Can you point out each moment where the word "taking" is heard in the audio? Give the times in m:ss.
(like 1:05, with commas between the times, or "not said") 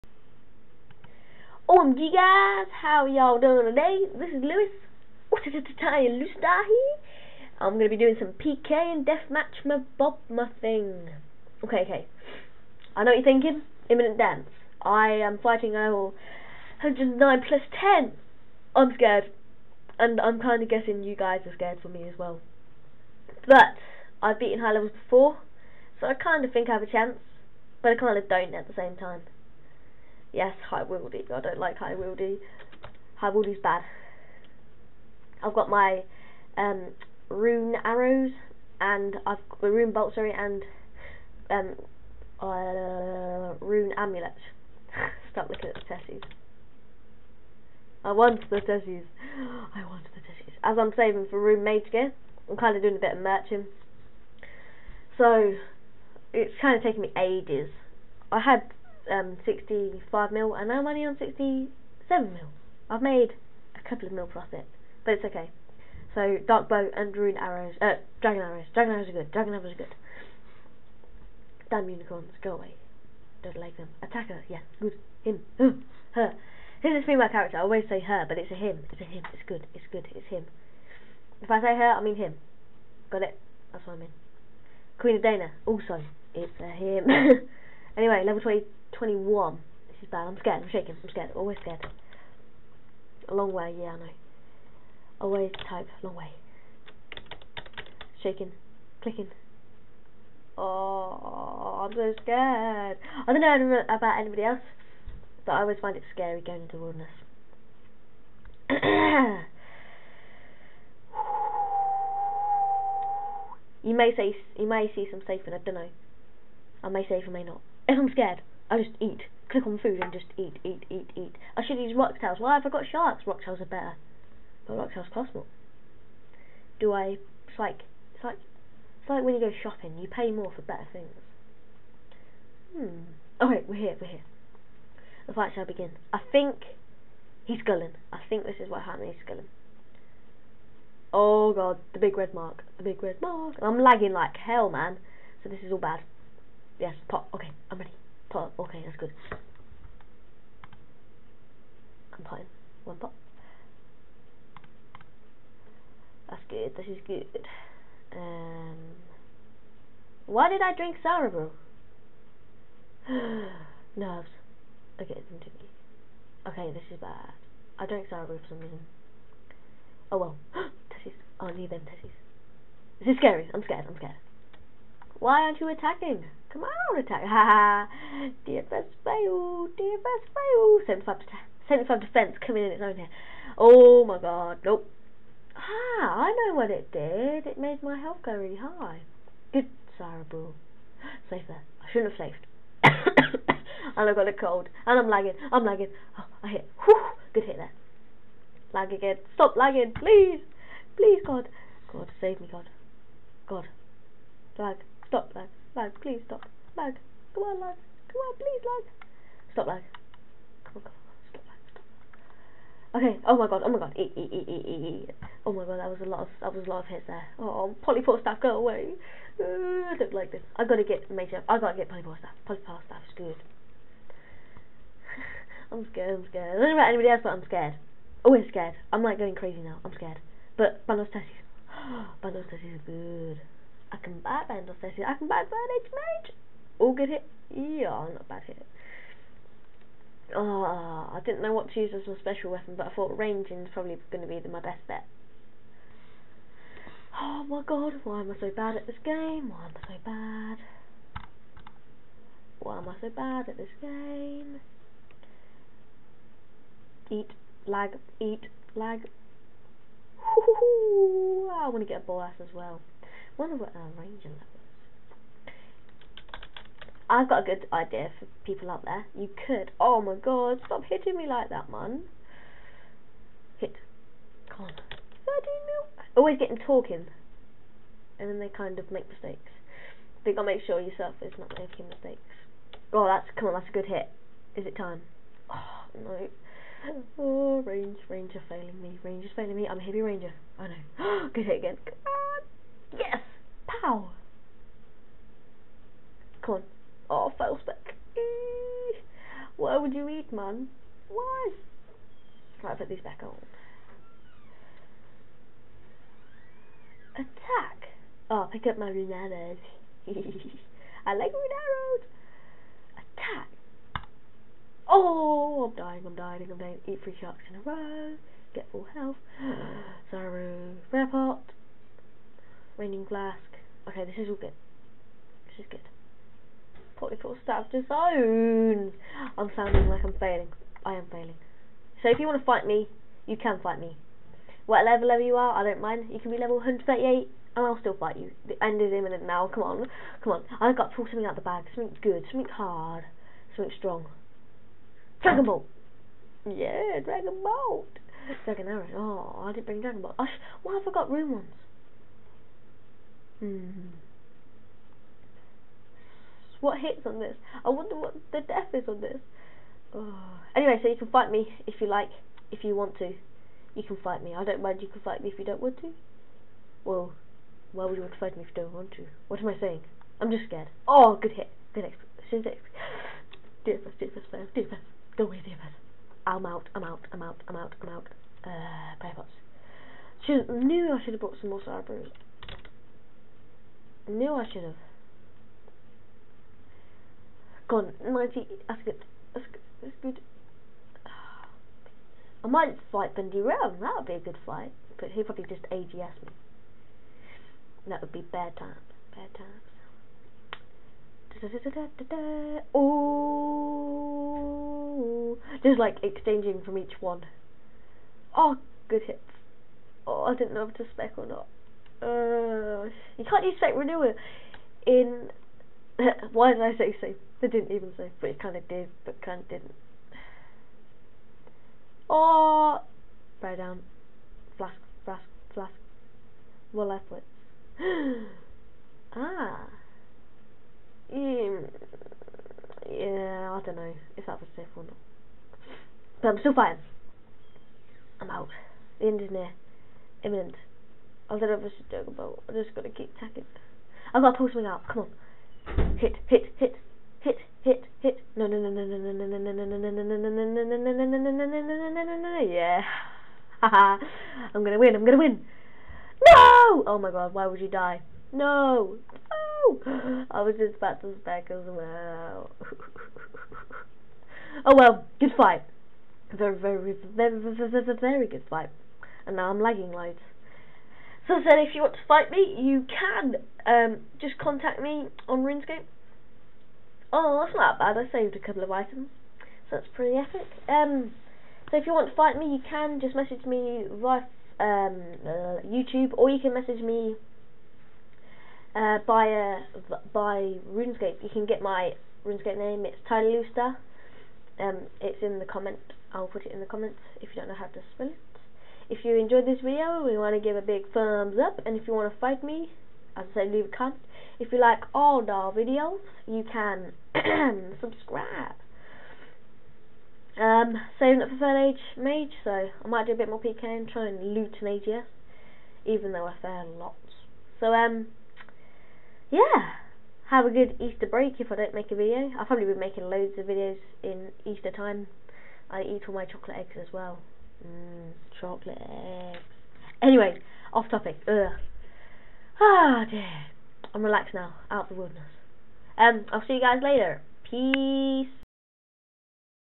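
0:56.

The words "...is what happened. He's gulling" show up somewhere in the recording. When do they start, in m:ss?
2:18.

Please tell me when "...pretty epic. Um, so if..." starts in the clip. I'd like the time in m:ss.
7:59.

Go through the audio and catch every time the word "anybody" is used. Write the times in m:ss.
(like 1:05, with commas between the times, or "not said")
1:44, 3:46.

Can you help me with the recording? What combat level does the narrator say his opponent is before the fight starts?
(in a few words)
109.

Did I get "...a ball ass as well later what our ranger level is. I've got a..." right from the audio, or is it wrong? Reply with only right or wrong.
wrong.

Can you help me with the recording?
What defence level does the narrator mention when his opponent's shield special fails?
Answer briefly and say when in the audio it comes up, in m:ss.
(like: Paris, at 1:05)
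75, at 3:01.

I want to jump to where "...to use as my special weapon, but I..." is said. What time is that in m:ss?
4:01.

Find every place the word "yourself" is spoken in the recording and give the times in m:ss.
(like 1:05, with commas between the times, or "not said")
4:40.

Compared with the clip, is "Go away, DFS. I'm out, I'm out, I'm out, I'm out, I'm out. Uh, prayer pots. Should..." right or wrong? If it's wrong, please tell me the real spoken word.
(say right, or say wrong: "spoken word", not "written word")
right.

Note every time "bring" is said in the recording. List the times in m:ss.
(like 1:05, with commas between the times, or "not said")
5:49.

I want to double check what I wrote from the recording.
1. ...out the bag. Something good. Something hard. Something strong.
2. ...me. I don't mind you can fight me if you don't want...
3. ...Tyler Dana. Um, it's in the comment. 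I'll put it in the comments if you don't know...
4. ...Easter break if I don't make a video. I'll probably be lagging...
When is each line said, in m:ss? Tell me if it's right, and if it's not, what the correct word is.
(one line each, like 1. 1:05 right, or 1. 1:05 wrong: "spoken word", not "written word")
1. 5:41 right
2. 6:04 right
3. 8:13 wrong: "Loustar", not "Dana"
4. 8:40 wrong: "making", not "lagging".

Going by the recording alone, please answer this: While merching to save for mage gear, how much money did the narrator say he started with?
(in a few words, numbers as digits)
65 mil.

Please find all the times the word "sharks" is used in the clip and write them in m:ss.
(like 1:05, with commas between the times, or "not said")
2:02, 5:17.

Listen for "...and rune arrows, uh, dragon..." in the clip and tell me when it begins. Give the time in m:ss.
1:06.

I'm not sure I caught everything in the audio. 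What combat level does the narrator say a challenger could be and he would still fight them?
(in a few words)
138.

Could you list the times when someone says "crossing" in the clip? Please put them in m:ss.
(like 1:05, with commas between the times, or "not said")
not said.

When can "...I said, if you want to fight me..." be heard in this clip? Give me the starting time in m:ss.
7:51.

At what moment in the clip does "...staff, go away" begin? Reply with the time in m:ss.
3:38.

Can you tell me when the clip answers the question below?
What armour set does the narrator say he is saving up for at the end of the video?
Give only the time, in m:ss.
8:31.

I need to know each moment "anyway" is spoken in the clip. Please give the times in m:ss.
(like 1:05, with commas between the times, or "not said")
1:27, 6:00, 8:50.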